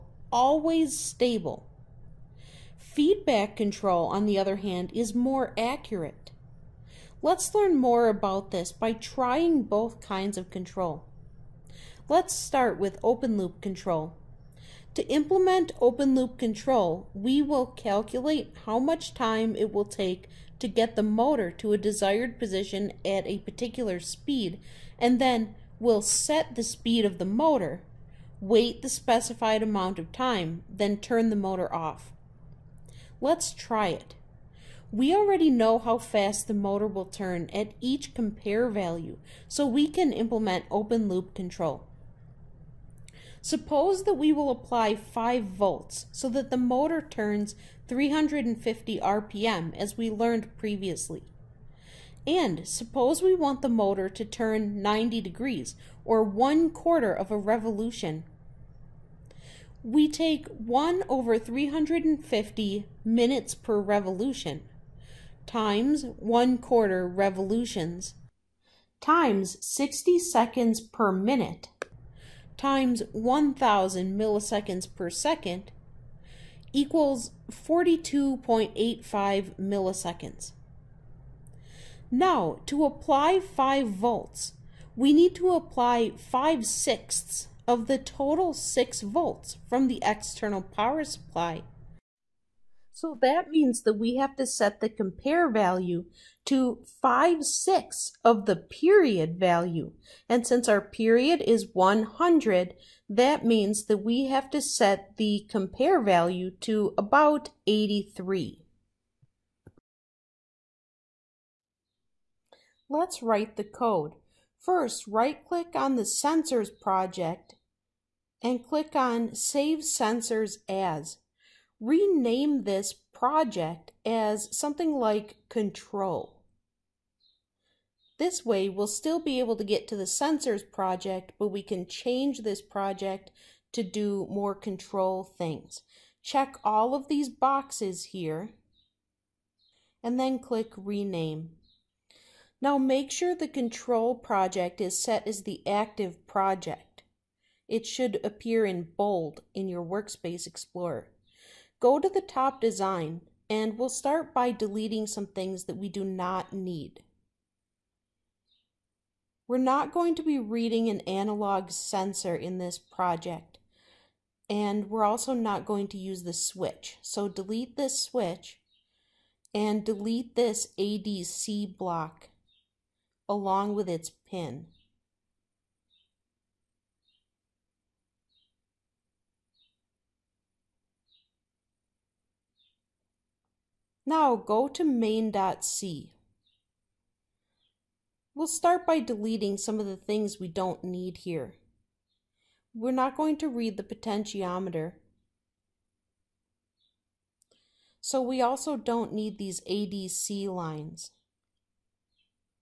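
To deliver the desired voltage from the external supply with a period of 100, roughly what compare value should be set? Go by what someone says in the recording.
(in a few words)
83.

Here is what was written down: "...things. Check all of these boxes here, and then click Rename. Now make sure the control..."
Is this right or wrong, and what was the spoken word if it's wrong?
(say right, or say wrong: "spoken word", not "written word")
right.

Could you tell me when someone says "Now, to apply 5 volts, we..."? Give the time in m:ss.
1:22.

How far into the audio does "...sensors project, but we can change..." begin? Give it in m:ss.
2:10.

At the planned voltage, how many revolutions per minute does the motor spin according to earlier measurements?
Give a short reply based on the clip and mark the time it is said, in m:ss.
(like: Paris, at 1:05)
350, at 0:47.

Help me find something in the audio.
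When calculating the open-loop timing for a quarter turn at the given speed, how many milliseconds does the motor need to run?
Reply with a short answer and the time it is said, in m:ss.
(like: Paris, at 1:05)
42.85, at 1:17.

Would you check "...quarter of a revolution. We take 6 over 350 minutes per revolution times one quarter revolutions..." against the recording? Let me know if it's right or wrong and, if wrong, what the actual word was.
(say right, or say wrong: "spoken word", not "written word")
wrong: "1", not "6".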